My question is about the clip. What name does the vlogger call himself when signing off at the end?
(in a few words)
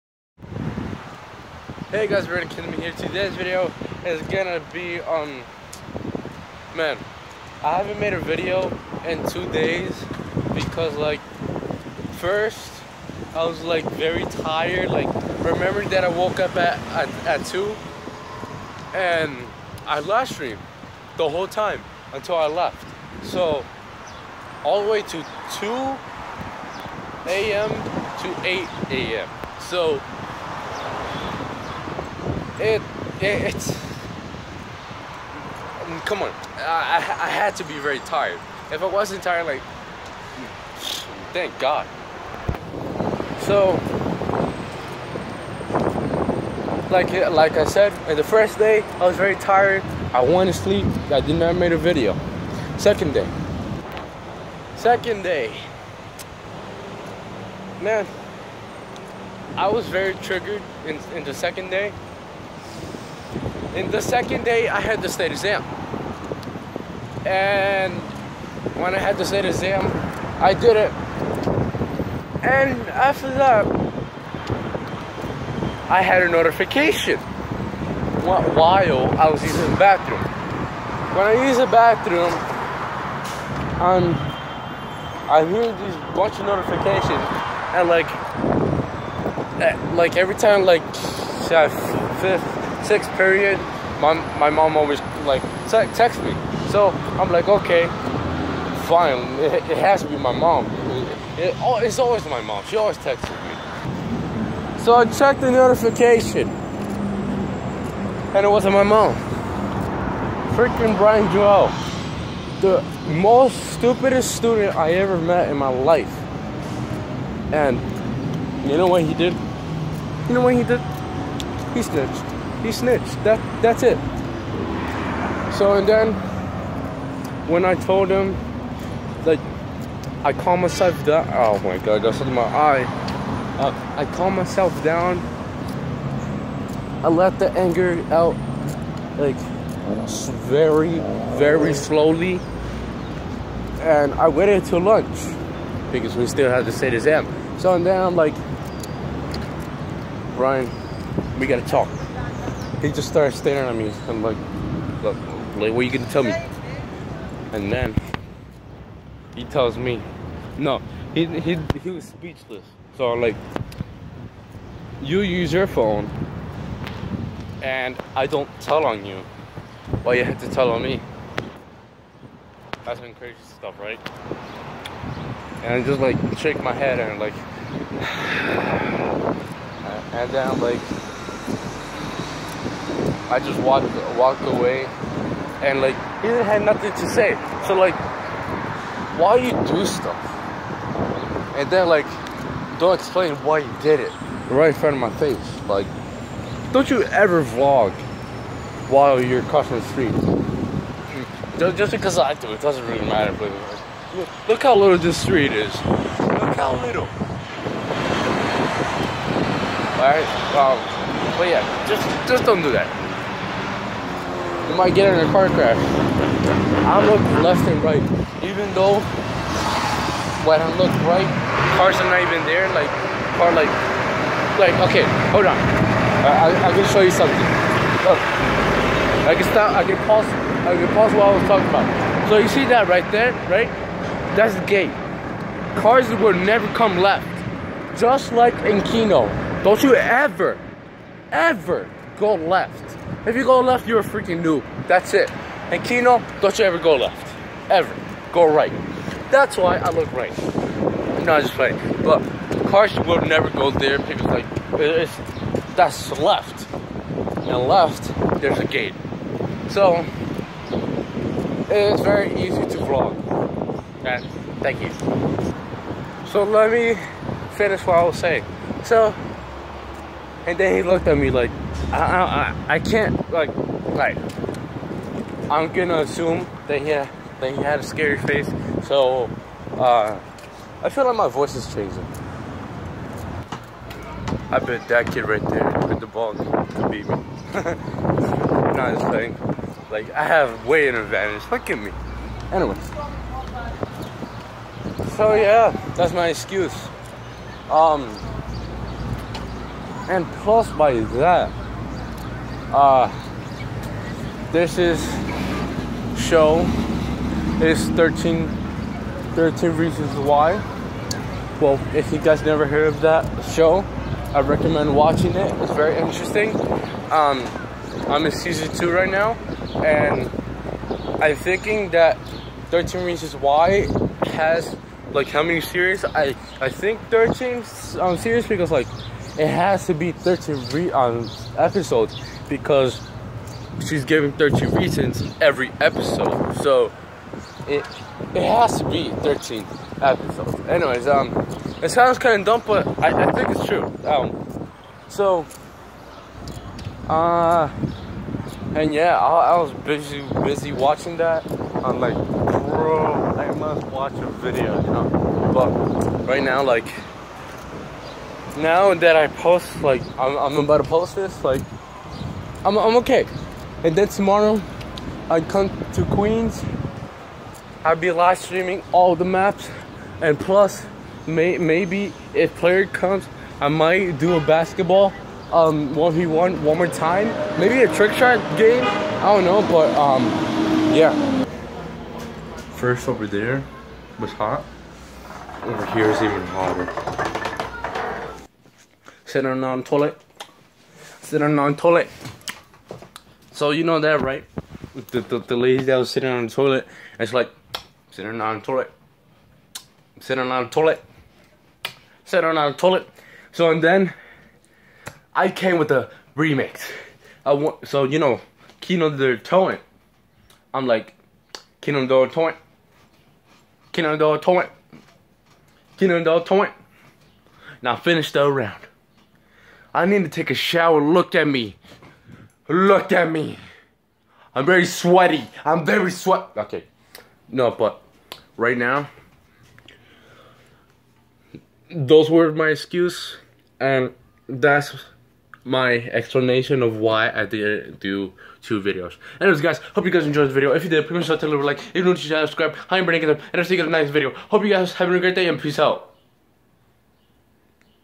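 Brandon.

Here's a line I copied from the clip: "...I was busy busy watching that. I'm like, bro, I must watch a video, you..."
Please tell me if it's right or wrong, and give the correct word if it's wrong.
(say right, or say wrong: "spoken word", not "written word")
right.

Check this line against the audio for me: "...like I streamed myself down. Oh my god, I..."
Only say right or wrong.
wrong.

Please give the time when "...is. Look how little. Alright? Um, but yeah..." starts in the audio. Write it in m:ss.
3:25.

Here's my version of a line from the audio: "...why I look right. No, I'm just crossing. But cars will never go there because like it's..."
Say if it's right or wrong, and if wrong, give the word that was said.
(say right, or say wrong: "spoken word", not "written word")
wrong: "playing", not "crossing".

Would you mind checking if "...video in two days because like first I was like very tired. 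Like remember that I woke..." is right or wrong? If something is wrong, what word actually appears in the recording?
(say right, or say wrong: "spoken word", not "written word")
right.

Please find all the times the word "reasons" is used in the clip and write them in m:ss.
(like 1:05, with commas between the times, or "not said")
5:09, 5:23, 5:34.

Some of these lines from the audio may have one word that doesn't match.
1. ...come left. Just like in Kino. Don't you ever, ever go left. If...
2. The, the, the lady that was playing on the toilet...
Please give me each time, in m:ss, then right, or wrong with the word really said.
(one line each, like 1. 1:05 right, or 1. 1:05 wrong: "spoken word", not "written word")
1. 3:56 right
2. 6:35 wrong: "sitting", not "playing".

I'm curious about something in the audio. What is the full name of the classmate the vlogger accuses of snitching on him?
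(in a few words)
Brian Joel.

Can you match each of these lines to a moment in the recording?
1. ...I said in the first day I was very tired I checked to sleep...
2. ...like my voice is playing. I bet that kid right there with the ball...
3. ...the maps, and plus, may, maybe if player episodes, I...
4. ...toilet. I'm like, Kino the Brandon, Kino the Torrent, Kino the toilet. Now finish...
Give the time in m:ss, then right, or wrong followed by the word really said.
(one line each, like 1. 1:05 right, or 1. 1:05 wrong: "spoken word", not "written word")
1. 0:47 wrong: "wanted", not "checked"
2. 4:41 wrong: "changing", not "playing"
3. 6:09 wrong: "comes", not "episodes"
4. 6:49 wrong: "Torrent", not "Brandon".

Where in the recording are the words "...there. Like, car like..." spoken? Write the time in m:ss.
3:42.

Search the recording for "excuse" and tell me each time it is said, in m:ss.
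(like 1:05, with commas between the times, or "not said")
4:56, 7:12.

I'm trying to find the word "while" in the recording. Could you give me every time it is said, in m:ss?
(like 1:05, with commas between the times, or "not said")
1:18, 3:18.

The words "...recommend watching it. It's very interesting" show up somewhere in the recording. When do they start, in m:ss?
5:14.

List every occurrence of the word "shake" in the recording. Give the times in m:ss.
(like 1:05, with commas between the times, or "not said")
2:56.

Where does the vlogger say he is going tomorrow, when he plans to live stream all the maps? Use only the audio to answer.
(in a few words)
Queens.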